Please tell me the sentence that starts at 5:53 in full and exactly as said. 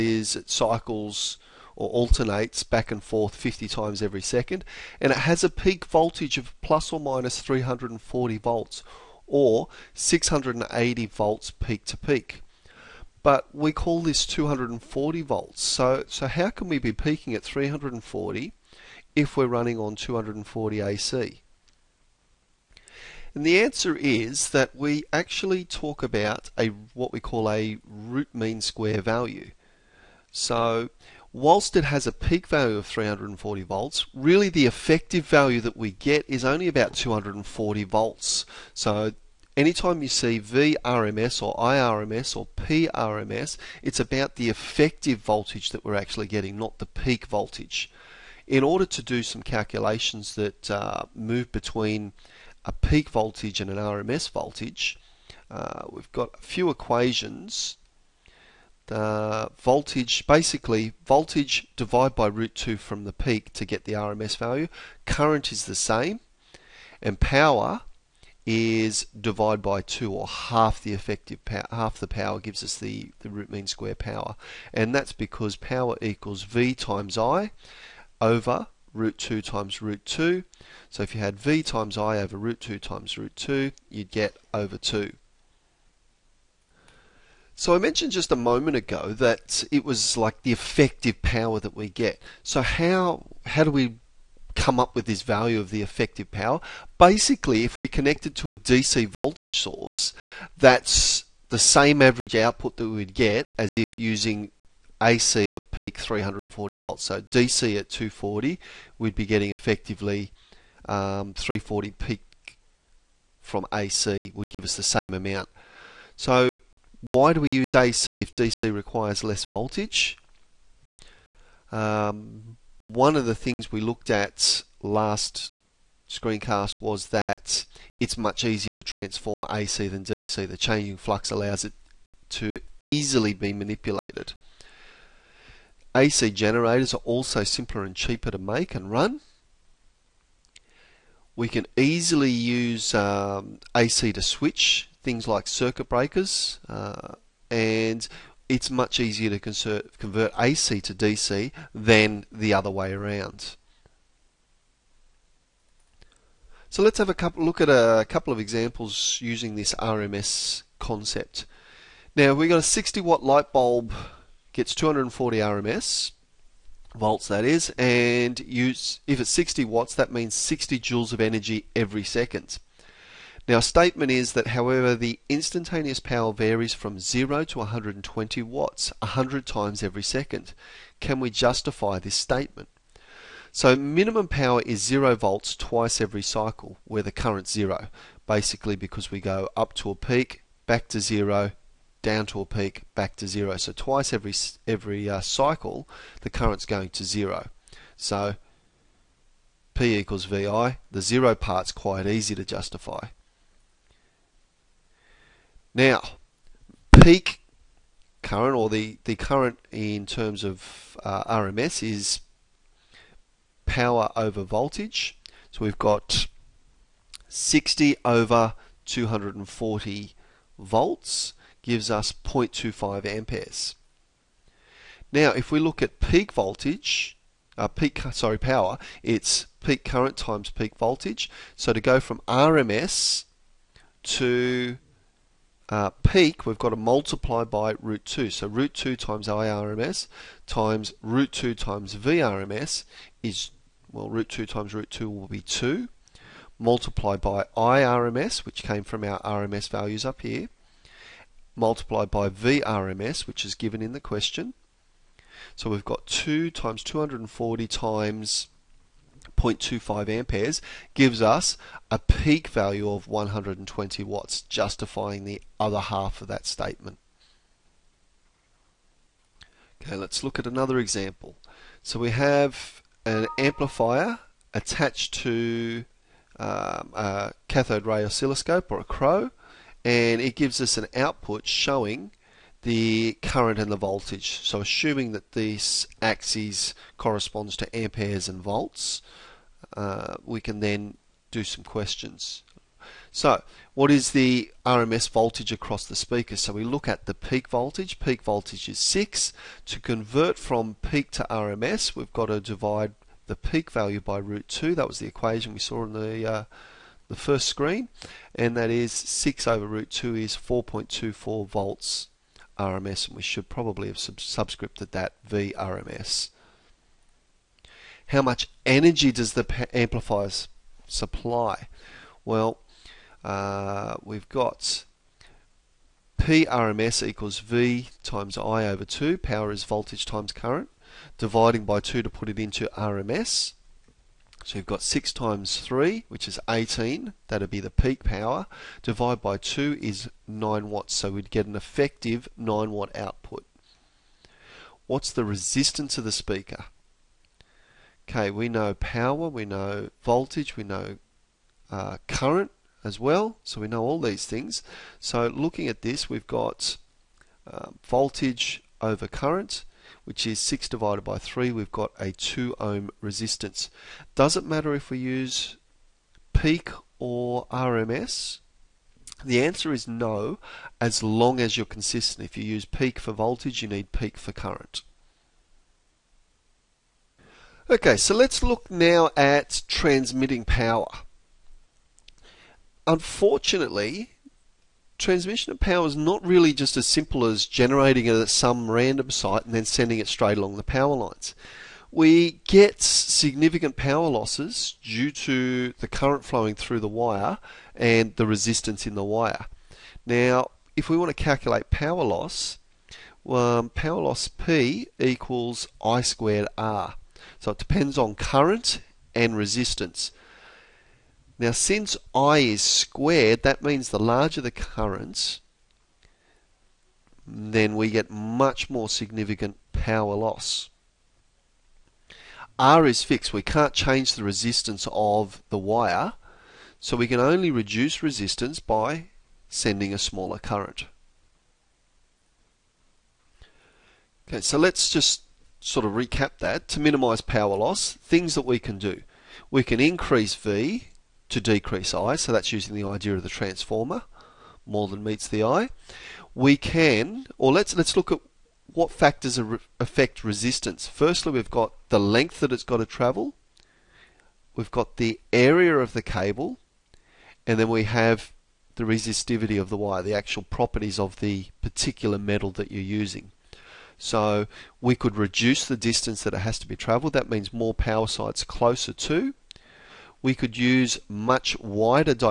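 So we know all these things.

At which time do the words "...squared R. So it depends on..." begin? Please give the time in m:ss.
6:45.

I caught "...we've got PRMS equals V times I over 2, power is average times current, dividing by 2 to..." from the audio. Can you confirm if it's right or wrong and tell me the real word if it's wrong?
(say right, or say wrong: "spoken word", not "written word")
wrong: "voltage", not "average".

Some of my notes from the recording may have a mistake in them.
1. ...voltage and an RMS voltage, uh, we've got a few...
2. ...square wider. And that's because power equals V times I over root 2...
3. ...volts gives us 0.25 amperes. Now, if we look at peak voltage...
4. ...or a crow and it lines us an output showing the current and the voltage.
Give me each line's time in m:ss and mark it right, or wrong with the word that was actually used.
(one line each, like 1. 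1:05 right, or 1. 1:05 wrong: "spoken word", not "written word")
1. 0:53 right
2. 1:13 wrong: "power", not "wider"
3. 3:40 right
4. 4:38 wrong: "gives", not "lines".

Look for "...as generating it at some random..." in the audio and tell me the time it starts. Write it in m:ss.
6:27.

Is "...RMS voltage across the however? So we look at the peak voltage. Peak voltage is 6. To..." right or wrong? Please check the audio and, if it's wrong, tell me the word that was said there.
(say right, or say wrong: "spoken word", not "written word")
wrong: "speaker", not "however".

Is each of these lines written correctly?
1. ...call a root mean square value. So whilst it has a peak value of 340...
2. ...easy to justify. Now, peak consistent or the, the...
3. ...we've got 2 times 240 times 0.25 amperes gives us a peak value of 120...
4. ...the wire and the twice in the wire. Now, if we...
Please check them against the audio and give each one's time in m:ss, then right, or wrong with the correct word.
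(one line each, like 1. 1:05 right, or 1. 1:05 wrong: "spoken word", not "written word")
1. 0:27 right
2. 3:22 wrong: "current", not "consistent"
3. 4:15 right
4. 6:36 wrong: "resistance", not "twice".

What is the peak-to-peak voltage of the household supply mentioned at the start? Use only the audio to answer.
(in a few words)
680 volts.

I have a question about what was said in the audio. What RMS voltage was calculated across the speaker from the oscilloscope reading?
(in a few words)
4.24 volts.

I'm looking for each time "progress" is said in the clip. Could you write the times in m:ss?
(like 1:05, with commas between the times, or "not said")
not said.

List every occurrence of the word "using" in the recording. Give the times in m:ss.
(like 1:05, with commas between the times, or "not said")
1:43, 2:39, 7:22, 7:42.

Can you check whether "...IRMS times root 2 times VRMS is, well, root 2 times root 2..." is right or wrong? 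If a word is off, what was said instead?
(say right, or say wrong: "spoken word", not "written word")
right.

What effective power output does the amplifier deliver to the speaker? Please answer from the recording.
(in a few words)
9 watts.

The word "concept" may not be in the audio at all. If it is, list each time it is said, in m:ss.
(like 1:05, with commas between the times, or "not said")
2:40.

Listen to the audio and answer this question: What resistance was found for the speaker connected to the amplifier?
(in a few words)
2 ohm.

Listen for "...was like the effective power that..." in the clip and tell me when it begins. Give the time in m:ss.
1:29.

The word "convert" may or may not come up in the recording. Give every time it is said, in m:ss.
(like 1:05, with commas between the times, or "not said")
2:29, 4:59.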